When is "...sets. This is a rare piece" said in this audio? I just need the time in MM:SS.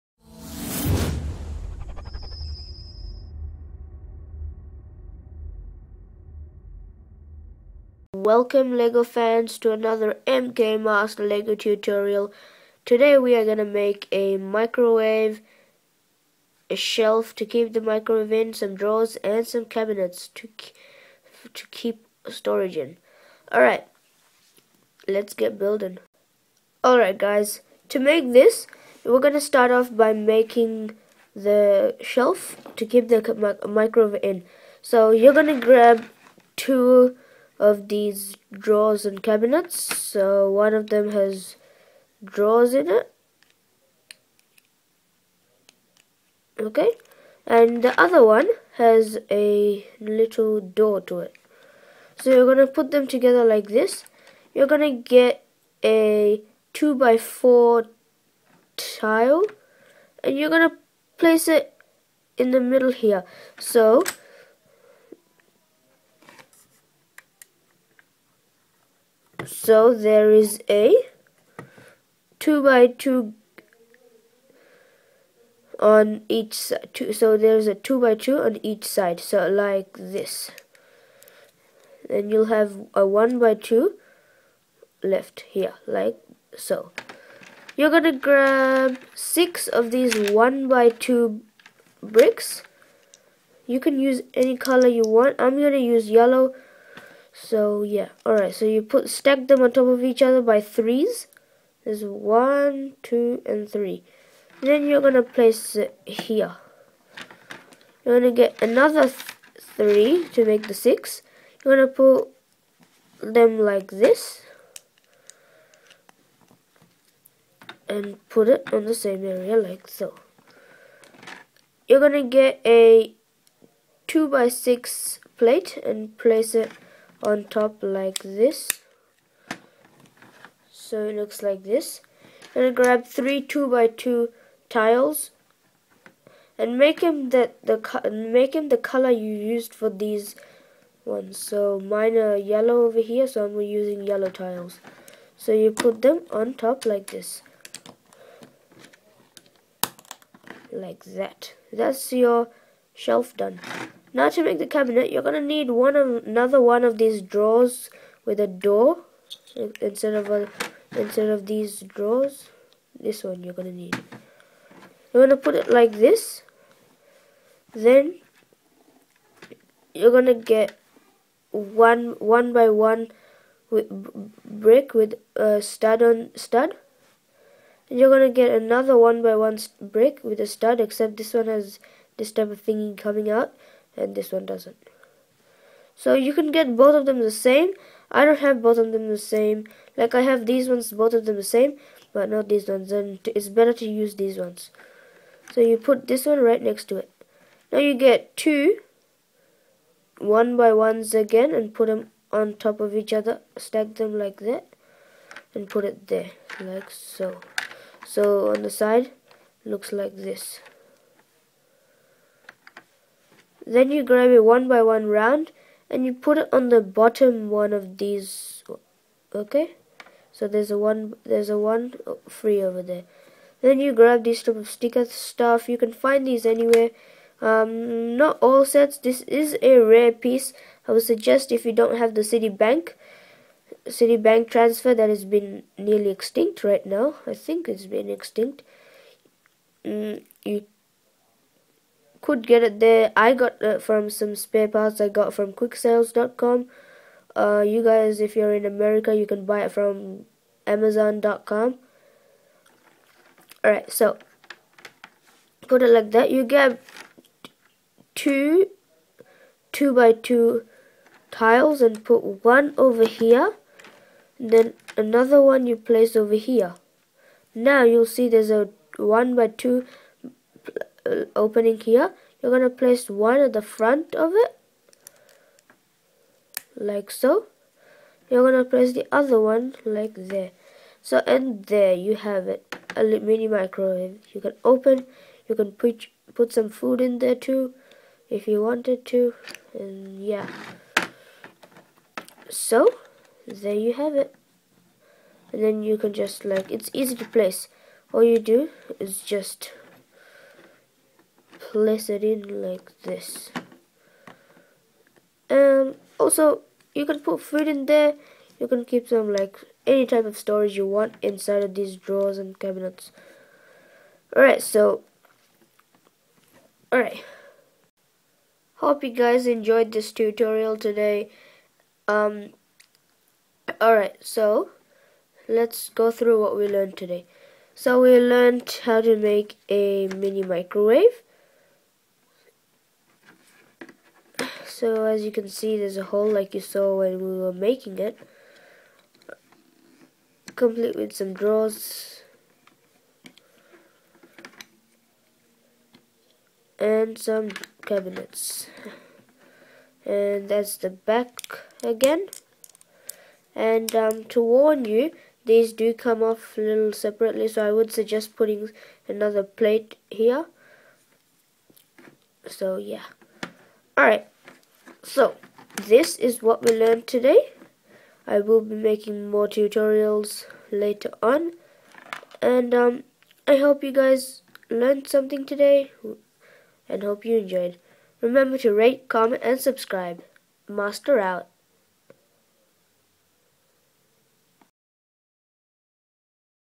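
03:48.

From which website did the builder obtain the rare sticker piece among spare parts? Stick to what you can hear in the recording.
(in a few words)
quicksales.com.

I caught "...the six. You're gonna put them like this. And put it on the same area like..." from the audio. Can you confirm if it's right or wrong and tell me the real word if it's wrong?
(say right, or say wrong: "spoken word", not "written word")
right.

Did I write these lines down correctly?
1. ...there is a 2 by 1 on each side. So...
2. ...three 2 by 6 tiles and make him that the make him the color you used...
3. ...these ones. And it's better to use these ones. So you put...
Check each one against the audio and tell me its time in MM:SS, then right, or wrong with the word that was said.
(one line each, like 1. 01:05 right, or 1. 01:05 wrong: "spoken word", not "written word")
1. 01:09 wrong: "2", not "1"
2. 02:13 wrong: "2", not "6"
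3. 03:12 right.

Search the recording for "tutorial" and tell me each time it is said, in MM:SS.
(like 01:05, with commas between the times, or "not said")
00:11, 05:20, 06:09.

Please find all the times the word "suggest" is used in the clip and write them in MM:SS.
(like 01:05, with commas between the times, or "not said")
03:51, 05:57.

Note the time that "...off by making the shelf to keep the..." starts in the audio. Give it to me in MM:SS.
00:29.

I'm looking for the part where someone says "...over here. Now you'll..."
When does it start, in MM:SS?
04:26.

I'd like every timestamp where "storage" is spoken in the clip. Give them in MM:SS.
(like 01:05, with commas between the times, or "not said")
00:22, 05:10.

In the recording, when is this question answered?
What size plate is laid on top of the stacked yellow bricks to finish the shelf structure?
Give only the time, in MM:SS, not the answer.
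02:04.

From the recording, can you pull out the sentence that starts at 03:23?
Stack them like that and put it there like so.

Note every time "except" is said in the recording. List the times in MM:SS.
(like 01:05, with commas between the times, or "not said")
03:00.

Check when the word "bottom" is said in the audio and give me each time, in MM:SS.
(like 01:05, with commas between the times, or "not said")
03:36.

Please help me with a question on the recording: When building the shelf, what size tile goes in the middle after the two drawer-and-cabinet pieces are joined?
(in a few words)
2 by 4.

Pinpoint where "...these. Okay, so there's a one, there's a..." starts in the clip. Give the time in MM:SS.
03:37.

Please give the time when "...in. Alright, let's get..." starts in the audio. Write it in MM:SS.
00:22.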